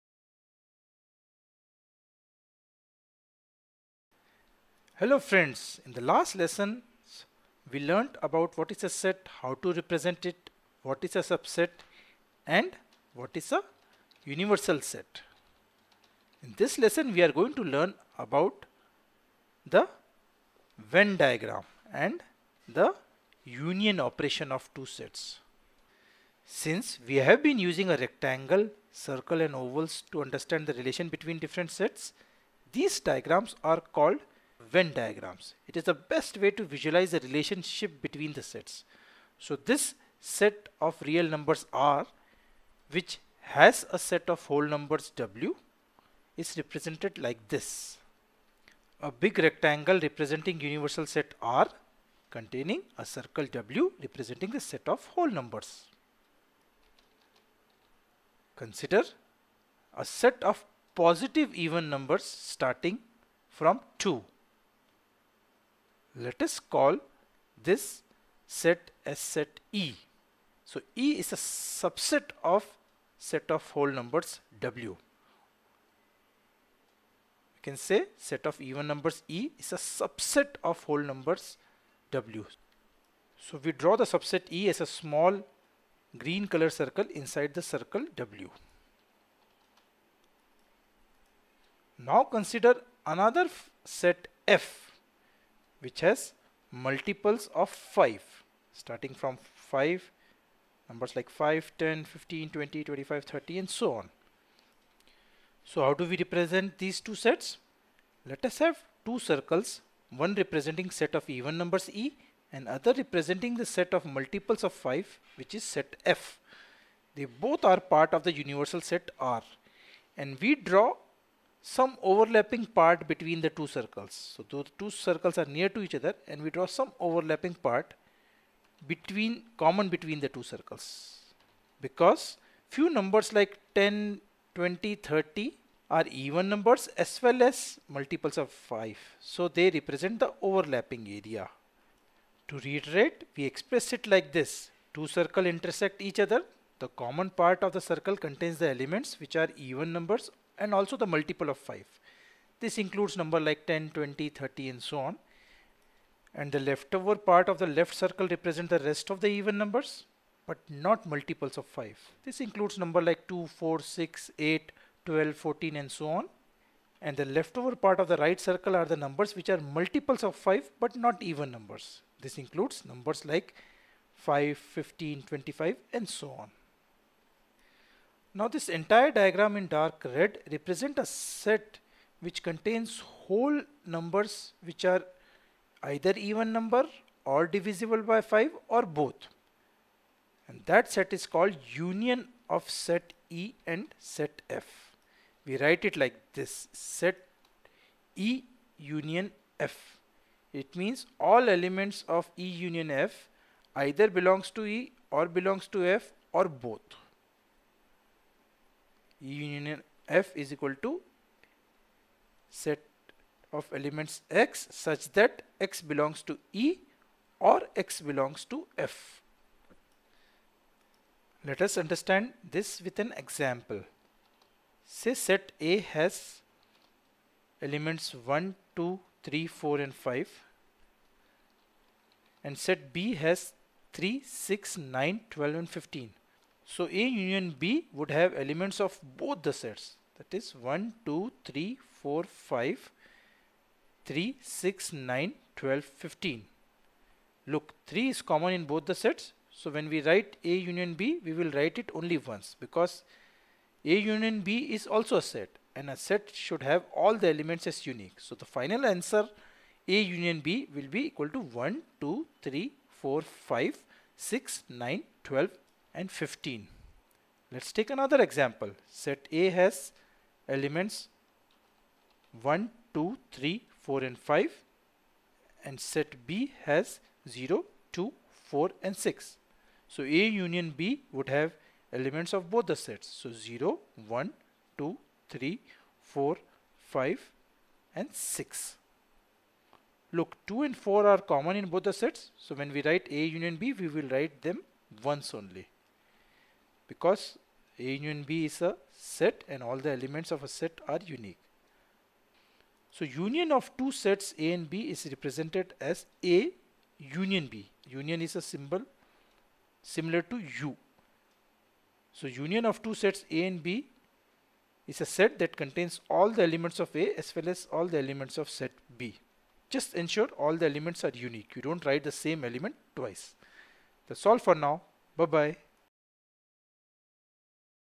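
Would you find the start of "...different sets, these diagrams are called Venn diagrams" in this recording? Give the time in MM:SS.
00:31.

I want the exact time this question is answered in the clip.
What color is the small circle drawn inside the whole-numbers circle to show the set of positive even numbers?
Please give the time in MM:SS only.
01:26.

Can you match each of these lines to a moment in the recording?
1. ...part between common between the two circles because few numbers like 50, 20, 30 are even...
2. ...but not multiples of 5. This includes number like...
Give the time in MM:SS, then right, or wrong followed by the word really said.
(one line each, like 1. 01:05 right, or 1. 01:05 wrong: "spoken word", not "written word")
1. 02:07 wrong: "10", not "50"
2. 02:40 right.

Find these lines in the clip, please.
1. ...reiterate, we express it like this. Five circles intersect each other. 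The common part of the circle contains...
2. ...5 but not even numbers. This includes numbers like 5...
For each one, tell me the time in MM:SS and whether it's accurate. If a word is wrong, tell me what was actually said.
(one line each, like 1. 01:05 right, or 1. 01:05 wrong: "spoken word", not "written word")
1. 02:22 wrong: "Two", not "Five"
2. 02:50 right.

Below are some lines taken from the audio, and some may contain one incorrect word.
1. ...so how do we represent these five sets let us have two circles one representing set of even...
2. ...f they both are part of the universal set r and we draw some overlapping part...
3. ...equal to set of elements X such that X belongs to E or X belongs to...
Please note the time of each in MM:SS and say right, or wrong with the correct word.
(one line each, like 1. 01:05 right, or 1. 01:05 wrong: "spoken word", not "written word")
1. 01:45 wrong: "two", not "five"
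2. 01:56 right
3. 03:30 right.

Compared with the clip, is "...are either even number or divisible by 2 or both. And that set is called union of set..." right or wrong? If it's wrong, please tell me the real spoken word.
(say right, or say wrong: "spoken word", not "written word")
wrong: "5", not "2".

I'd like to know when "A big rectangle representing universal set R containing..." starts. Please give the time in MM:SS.
00:49.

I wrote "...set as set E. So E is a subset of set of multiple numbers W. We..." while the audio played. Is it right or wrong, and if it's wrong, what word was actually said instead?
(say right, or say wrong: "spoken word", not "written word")
wrong: "whole", not "multiple".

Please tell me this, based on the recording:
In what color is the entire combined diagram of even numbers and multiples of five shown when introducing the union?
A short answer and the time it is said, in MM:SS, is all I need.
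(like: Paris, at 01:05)
dark red, at 02:59.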